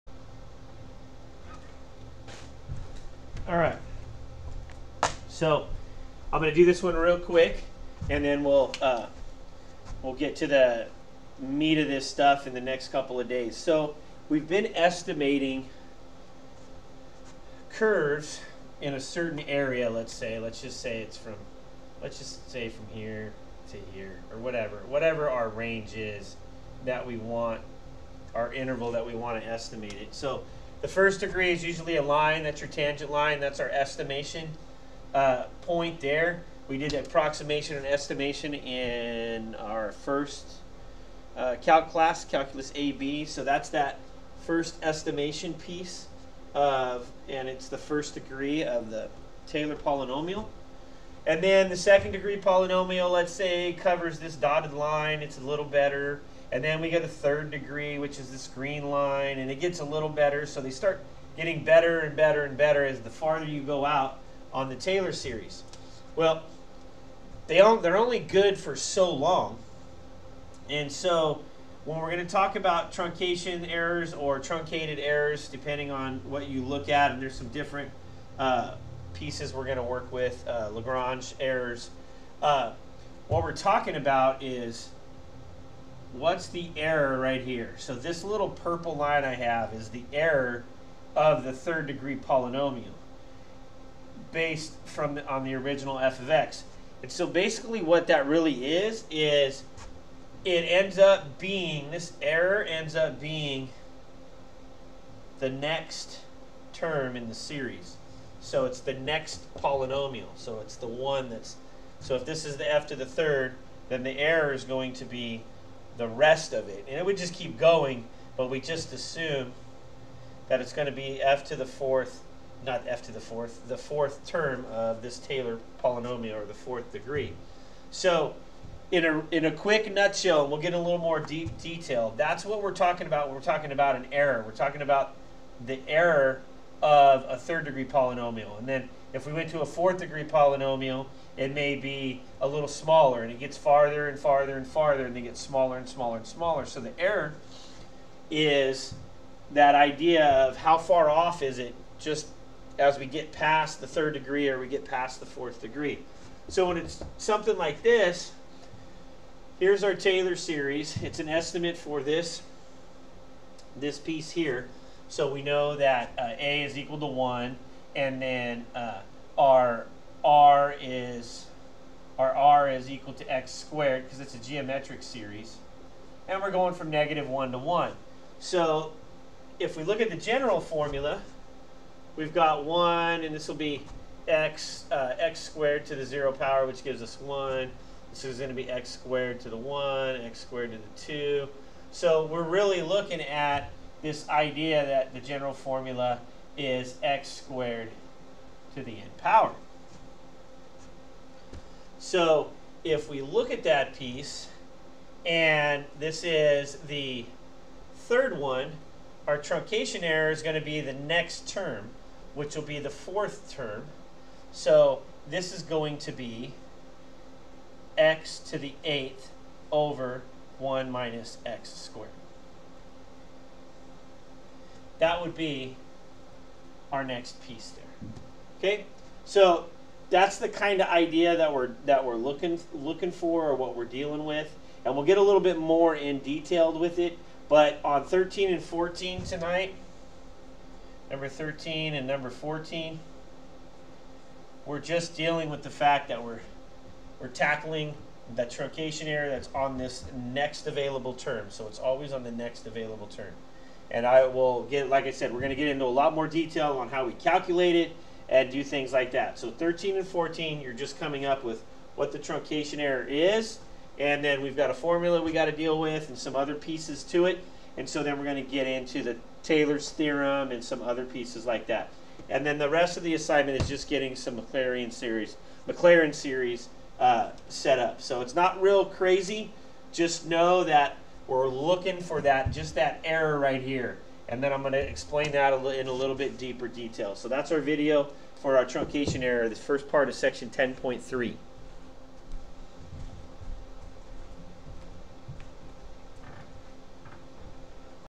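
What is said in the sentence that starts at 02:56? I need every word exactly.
And we're going from negative 1 to 1.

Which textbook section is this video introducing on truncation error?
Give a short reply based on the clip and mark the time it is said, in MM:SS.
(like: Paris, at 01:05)
10.3, at 04:50.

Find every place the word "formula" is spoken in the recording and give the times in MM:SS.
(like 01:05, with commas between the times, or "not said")
03:00, 03:15, 04:24.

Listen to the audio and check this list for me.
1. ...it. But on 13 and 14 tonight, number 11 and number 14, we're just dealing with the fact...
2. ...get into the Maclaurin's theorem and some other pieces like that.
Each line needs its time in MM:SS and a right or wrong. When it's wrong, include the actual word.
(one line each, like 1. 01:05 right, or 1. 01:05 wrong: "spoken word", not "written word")
1. 03:56 wrong: "13", not "11"
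2. 04:28 wrong: "Taylor", not "Maclaurin".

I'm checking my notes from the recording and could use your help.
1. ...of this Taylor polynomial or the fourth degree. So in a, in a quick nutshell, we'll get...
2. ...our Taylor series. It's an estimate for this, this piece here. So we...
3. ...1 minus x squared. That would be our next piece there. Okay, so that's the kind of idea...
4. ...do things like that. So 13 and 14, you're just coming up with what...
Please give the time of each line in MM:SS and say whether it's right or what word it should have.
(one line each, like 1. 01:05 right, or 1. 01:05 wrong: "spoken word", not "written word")
1. 02:04 right
2. 02:39 right
3. 03:40 right
4. 04:18 right.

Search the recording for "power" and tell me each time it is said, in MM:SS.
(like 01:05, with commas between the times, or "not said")
03:06, 03:19.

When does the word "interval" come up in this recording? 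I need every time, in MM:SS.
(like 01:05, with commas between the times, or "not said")
00:28.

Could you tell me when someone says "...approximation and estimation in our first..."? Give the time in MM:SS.
00:36.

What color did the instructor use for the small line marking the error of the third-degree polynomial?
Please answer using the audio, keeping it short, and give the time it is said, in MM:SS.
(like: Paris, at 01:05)
Purple, at 01:28.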